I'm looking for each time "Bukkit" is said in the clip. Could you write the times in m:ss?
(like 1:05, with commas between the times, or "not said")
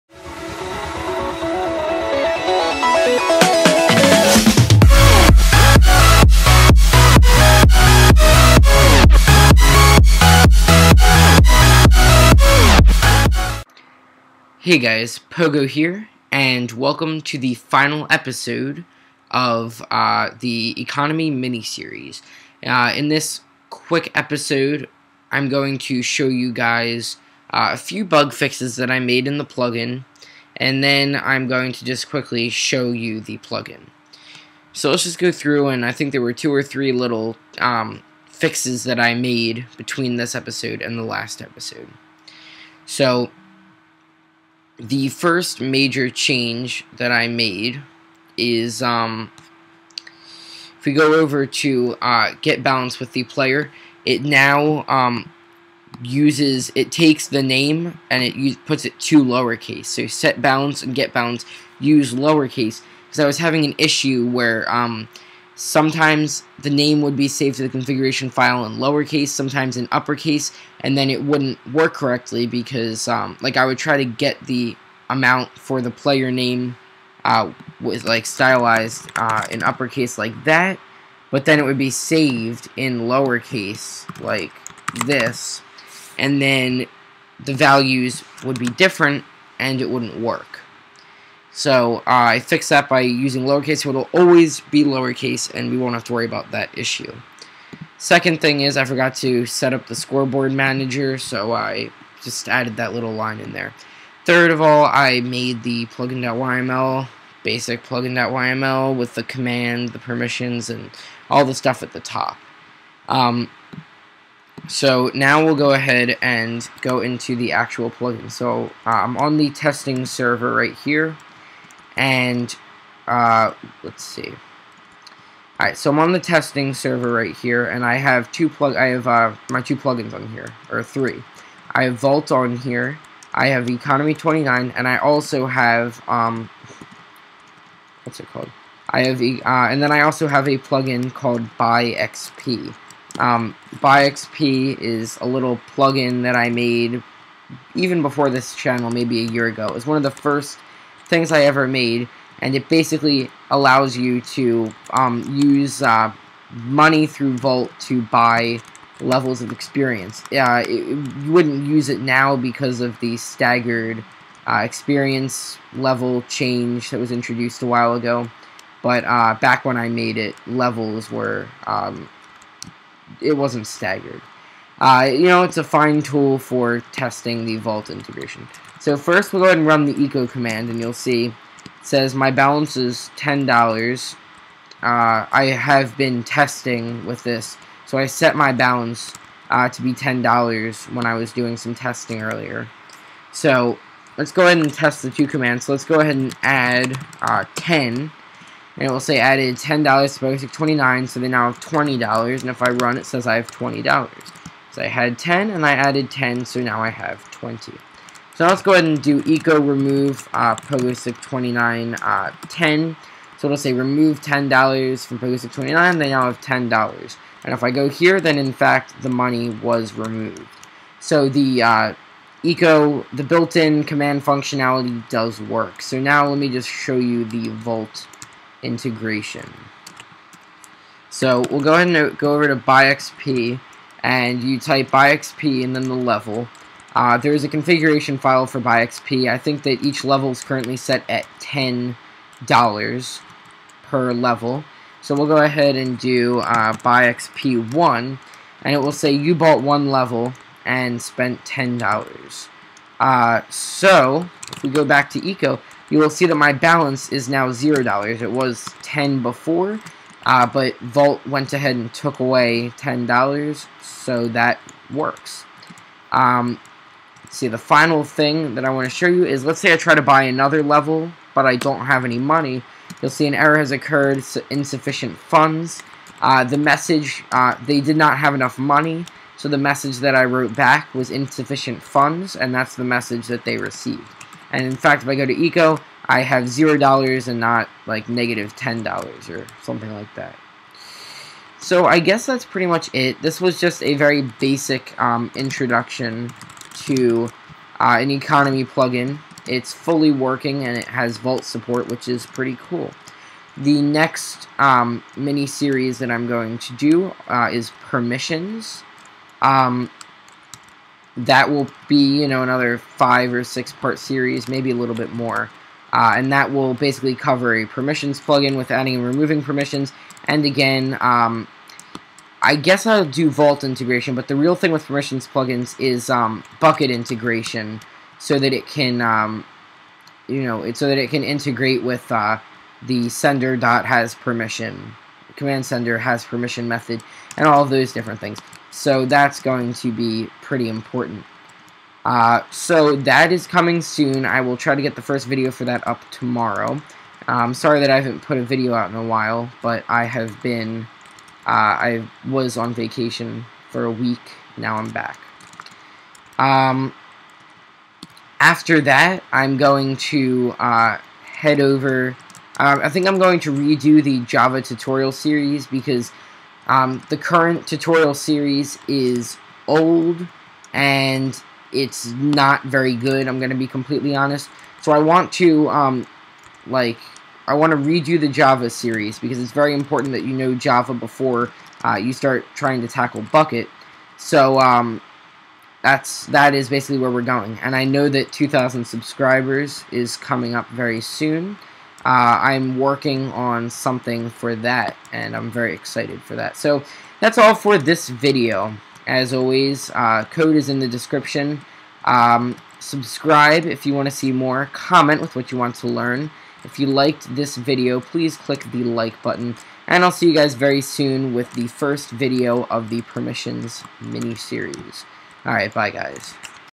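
5:26, 6:23.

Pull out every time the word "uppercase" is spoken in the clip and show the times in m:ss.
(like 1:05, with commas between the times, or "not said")
1:09, 1:19.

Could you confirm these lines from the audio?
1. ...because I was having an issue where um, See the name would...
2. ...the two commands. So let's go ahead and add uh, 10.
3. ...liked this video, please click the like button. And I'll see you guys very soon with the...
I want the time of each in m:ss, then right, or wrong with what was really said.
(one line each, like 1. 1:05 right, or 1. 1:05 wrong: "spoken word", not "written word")
1. 1:03 wrong: "Sometimes", not "See"
2. 3:15 right
3. 6:46 right.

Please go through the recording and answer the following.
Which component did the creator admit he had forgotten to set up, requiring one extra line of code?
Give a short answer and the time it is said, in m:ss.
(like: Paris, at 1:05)
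scoreboard manager, at 1:39.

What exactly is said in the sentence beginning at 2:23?
Um, Buy XP is a little plugin that I made even before this channel, maybe a year ago.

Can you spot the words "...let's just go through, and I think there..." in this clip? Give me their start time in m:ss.
0:34.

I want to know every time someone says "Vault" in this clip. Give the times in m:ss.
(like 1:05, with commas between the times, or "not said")
2:11, 2:37, 2:57, 3:47, 4:20, 5:01, 5:23.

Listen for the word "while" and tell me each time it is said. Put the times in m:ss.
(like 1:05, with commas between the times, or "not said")
2:47, 5:49.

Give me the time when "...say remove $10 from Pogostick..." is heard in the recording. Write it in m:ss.
3:33.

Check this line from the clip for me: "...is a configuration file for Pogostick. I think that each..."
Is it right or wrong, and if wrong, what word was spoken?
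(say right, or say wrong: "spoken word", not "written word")
wrong: "BuyXP", not "Pogostick".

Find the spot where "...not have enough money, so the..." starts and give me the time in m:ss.
4:37.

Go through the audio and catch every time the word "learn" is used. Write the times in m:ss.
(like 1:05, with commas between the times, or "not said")
6:45.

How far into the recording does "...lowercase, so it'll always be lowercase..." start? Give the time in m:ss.
1:33.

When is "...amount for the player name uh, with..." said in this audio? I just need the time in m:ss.
1:15.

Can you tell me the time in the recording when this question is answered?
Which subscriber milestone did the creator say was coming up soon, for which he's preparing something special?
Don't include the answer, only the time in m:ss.
6:28.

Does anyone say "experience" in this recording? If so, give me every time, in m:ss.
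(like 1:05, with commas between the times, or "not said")
2:39, 2:44.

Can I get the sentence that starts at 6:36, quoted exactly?
So that's all for this video.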